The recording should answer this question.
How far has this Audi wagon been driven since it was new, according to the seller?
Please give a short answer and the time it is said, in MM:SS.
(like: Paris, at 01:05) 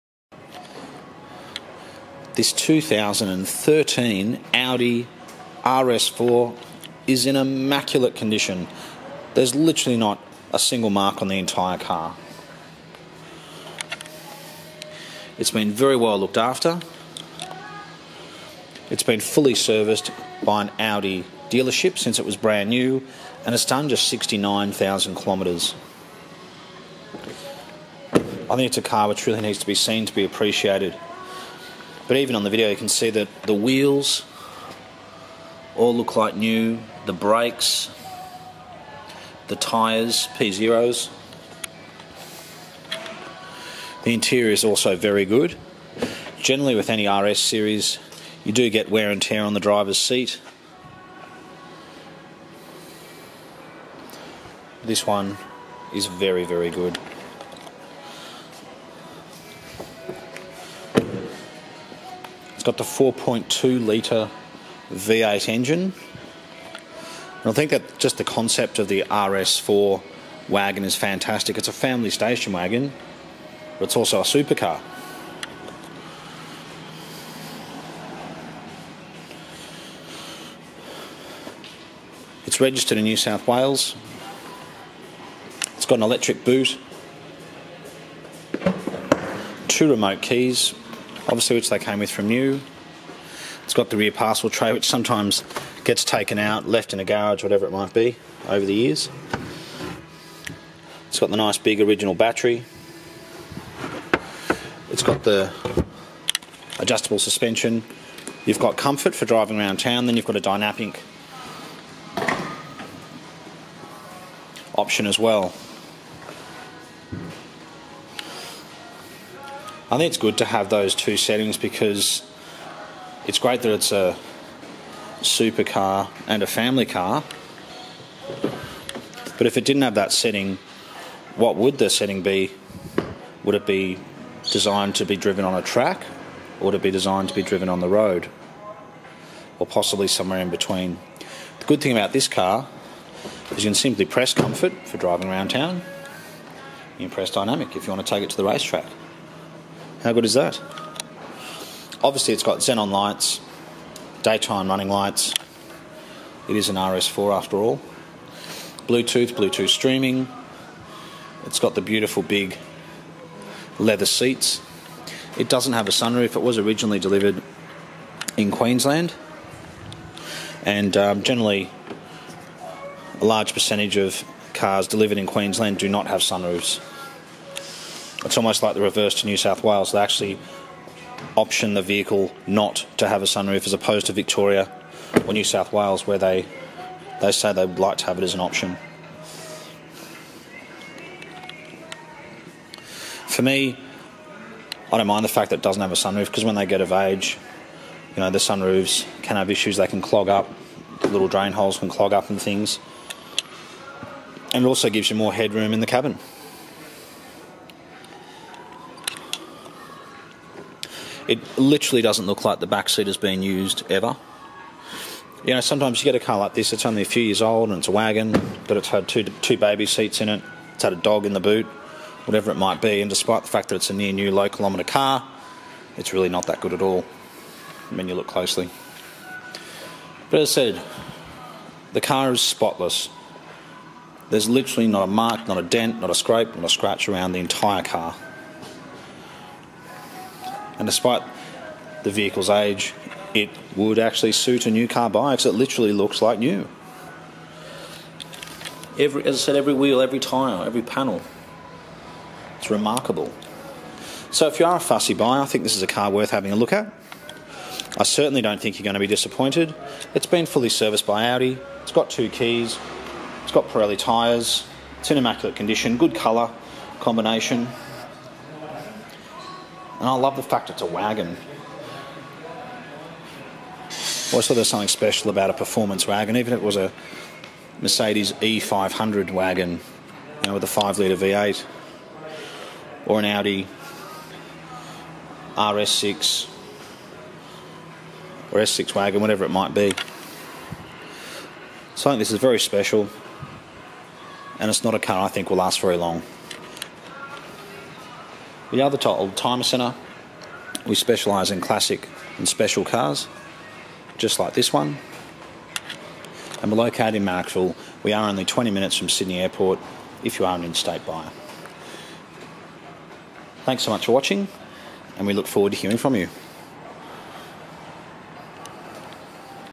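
69,000 kilometres, at 00:24.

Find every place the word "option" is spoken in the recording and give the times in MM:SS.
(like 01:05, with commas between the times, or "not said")
01:54, 03:01, 03:08.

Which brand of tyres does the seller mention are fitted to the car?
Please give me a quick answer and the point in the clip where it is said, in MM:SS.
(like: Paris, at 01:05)
Pirelli, at 04:23.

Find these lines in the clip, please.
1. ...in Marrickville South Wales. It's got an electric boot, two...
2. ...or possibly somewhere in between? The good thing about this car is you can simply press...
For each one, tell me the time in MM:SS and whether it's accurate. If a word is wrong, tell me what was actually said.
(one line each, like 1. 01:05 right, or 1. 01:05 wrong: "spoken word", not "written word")
1. 01:22 wrong: "New", not "Marrickville"
2. 02:19 right.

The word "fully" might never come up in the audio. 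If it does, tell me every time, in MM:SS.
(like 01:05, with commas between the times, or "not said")
00:19, 04:20.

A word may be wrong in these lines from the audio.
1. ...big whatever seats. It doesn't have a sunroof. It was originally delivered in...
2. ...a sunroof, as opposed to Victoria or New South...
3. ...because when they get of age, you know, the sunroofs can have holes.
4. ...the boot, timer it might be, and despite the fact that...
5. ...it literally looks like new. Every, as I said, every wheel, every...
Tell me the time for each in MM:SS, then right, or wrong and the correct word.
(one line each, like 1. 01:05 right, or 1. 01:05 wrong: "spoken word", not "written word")
1. 02:42 wrong: "leather", not "whatever"
2. 03:03 right
3. 03:16 wrong: "issues", not "holes"
4. 03:41 wrong: "whatever", not "timer"
5. 04:05 right.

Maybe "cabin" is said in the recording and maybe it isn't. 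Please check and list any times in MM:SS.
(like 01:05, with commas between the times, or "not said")
03:25.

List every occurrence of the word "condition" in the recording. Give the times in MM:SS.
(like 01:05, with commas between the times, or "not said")
00:08, 04:25.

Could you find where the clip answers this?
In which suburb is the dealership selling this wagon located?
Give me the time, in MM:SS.
05:07.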